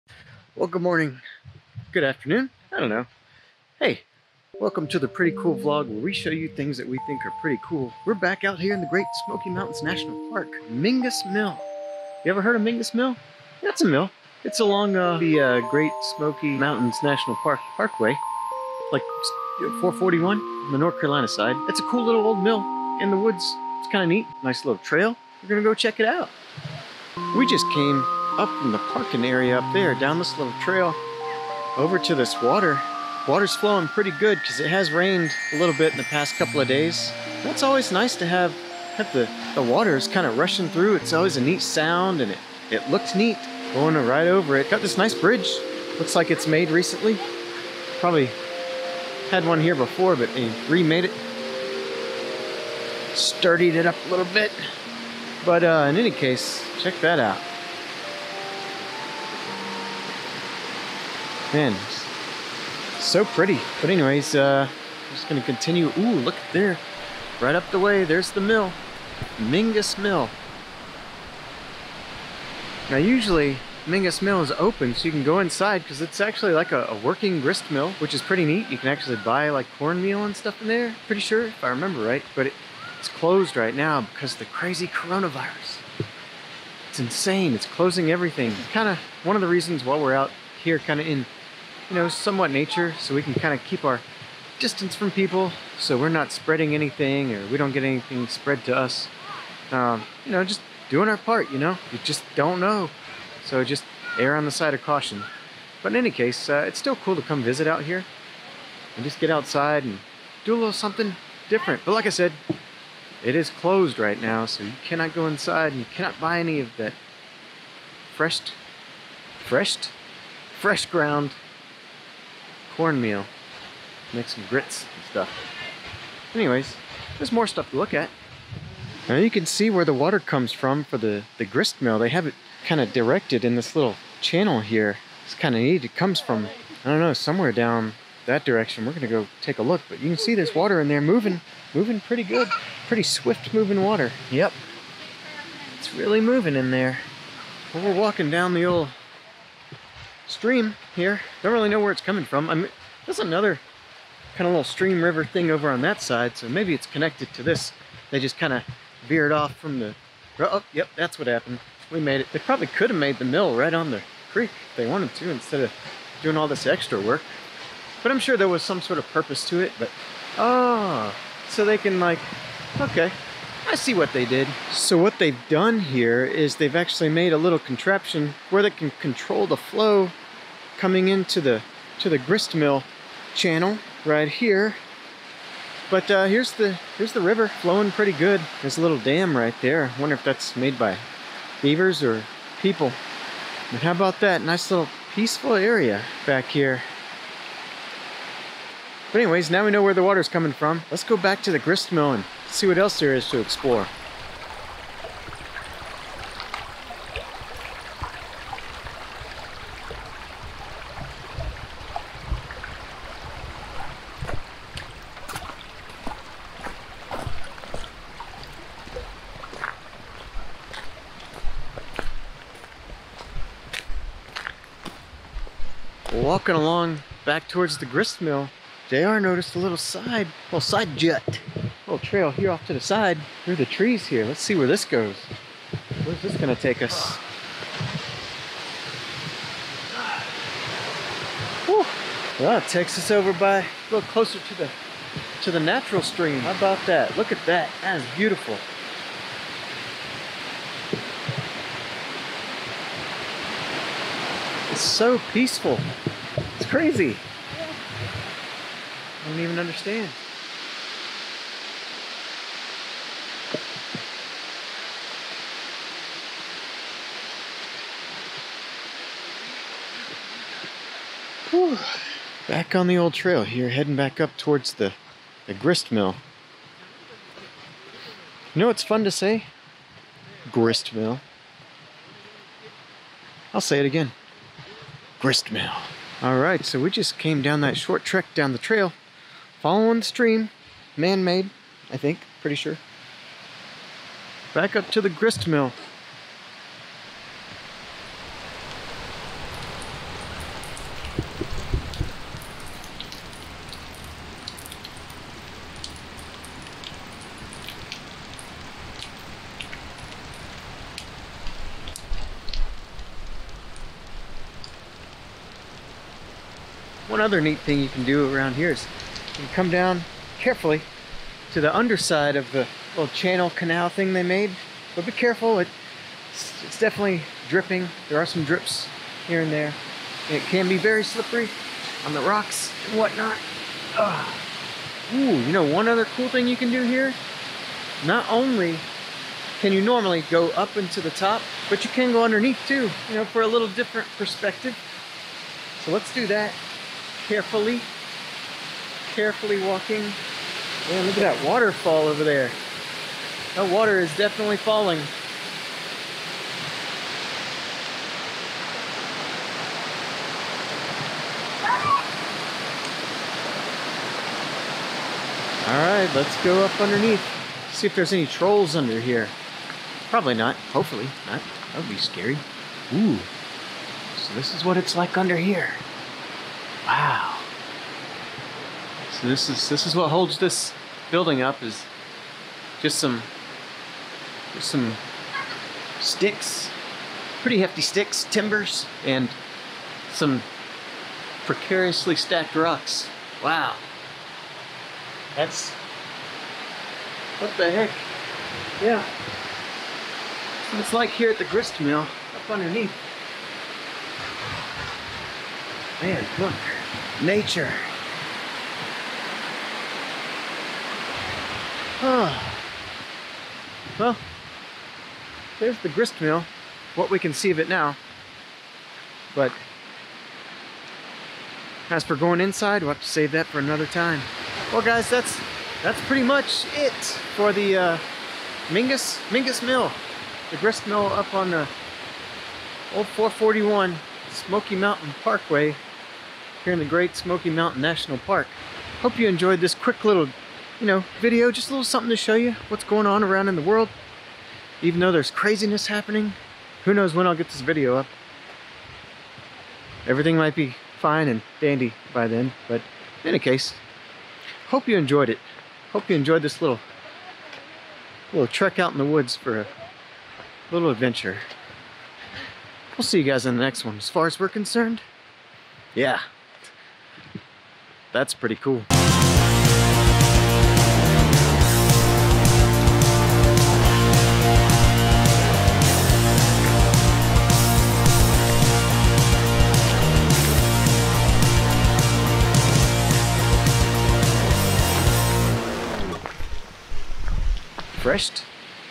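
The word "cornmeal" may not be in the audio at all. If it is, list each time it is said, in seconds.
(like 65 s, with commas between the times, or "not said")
79 s, 122 s.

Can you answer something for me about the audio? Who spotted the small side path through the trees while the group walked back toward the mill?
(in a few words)
JR.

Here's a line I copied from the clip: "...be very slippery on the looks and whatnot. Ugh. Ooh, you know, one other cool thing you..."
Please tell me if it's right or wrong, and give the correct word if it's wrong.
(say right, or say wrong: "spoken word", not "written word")
wrong: "rocks", not "looks".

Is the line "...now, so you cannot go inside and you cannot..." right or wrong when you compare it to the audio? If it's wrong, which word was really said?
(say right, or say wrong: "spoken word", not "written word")
right.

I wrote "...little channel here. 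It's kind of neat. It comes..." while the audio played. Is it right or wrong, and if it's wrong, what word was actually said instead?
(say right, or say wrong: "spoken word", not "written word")
right.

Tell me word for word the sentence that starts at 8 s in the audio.
We're back out here in the Great Smoky Mountains National Park, Mingus Mill.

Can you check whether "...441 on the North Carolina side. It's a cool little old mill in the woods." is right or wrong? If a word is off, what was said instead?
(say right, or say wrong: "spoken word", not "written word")
right.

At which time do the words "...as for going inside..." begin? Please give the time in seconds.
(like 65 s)
421 s.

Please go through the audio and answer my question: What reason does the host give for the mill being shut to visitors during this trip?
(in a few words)
Coronavirus.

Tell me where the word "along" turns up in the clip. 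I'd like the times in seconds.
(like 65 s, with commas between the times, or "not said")
14 s, 226 s.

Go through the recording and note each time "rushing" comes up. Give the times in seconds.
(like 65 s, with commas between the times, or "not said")
40 s.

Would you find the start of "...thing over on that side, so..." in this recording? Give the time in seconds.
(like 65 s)
155 s.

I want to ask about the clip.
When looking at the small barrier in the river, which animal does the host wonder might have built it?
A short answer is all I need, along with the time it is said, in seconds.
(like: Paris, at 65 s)
Beavers, at 191 s.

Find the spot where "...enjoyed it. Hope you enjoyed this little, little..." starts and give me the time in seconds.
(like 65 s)
454 s.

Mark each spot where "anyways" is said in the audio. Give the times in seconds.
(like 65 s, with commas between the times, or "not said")
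63 s, 126 s, 199 s.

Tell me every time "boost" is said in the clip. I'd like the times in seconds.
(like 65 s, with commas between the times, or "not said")
not said.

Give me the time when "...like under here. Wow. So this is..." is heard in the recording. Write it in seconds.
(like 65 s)
374 s.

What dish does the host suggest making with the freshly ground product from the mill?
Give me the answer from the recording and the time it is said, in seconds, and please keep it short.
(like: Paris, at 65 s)
Grits, at 124 s.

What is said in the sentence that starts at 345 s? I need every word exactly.
So let's do that carefully, carefully walking.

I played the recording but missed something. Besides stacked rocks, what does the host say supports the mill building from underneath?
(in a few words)
Timbers.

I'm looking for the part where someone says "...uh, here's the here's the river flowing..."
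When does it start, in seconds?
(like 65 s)
186 s.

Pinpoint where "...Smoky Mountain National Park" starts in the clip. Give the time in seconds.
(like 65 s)
437 s.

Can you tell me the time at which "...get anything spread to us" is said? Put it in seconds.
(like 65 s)
97 s.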